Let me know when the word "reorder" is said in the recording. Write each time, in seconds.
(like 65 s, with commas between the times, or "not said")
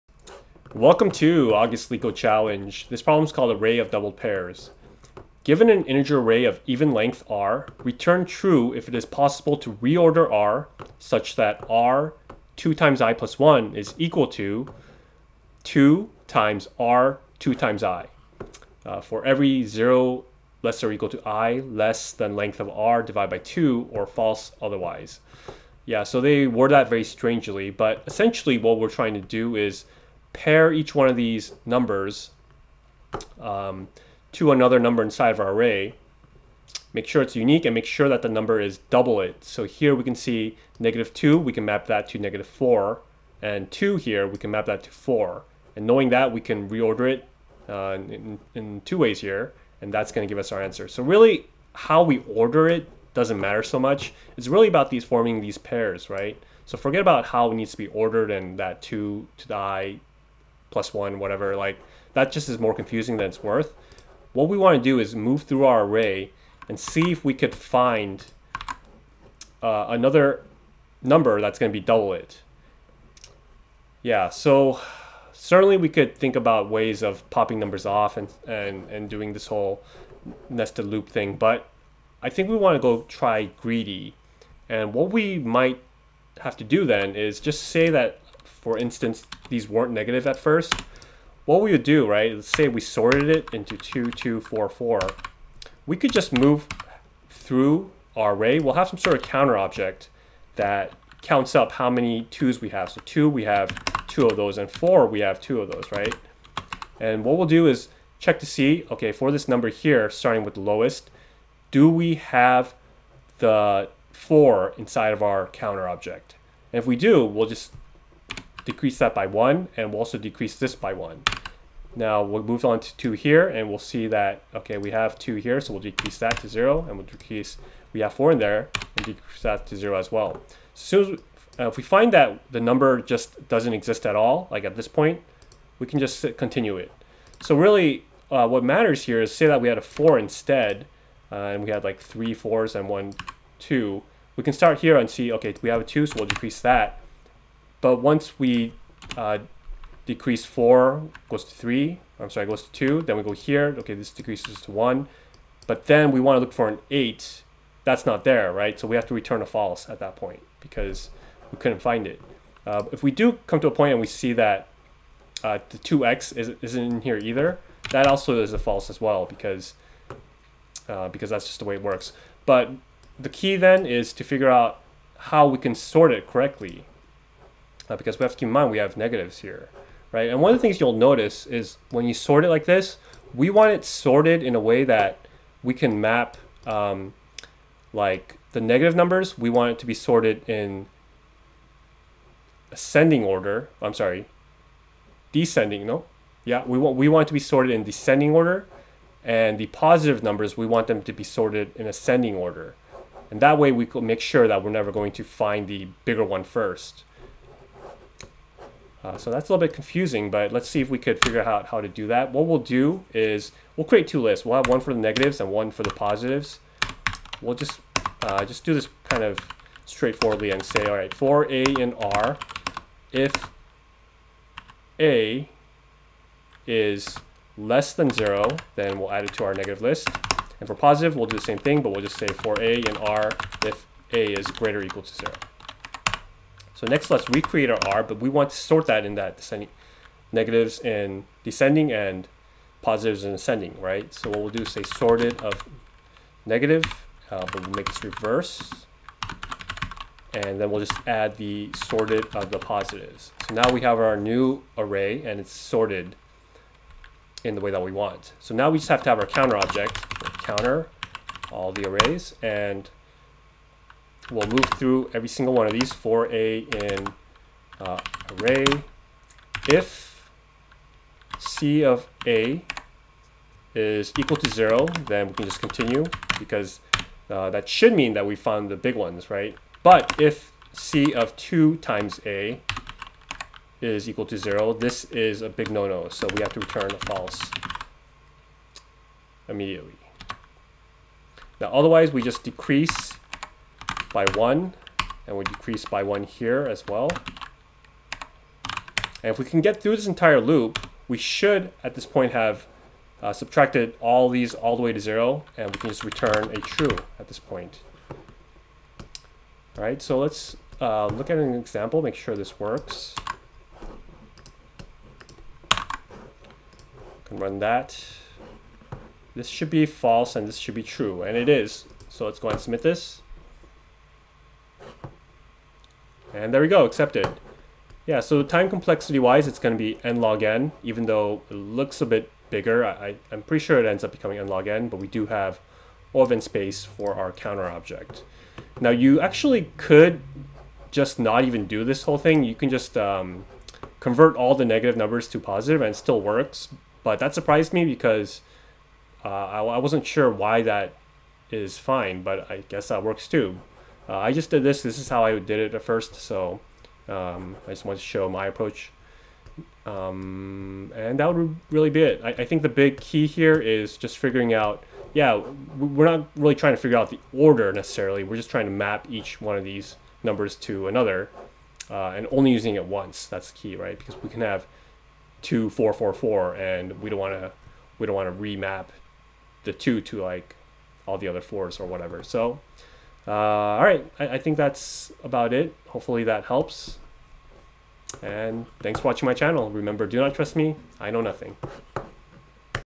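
9 s, 46 s.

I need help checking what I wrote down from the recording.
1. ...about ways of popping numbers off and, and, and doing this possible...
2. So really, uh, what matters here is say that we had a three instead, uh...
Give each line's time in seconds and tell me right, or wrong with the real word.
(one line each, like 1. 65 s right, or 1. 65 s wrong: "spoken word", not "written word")
1. 76 s wrong: "whole", not "possible"
2. 137 s wrong: "four", not "three".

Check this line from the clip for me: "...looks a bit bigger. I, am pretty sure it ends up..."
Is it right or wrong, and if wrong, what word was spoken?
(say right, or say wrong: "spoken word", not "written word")
right.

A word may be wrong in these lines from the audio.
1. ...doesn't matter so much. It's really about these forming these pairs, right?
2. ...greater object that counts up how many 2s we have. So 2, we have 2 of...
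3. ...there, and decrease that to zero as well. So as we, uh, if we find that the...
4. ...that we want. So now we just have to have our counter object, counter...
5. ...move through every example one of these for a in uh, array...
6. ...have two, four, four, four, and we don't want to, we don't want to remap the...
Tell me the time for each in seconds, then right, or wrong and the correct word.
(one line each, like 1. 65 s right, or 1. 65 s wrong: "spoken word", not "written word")
1. 53 s right
2. 99 s wrong: "counter", not "greater"
3. 128 s right
4. 257 s right
5. 264 s wrong: "single", not "example"
6. 374 s right.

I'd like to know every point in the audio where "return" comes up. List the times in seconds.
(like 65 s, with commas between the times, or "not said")
7 s, 159 s, 286 s, 306 s.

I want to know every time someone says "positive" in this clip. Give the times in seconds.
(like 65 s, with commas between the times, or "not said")
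199 s, 215 s, 230 s, 242 s, 252 s, 345 s.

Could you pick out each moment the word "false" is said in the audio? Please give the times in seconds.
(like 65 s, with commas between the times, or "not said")
24 s, 159 s, 168 s, 287 s, 319 s.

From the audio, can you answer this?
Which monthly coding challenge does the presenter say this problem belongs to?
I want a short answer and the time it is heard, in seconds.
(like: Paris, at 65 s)
August Leetcode Challenge, at 1 s.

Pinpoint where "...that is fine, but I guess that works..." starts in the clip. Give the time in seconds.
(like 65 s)
350 s.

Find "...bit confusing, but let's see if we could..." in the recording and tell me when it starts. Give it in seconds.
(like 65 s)
209 s.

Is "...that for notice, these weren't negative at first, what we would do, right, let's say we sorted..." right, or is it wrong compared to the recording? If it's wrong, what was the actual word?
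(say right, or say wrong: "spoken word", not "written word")
wrong: "instance", not "notice".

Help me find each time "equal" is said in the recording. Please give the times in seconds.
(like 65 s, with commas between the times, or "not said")
13 s, 20 s, 234 s, 274 s, 284 s.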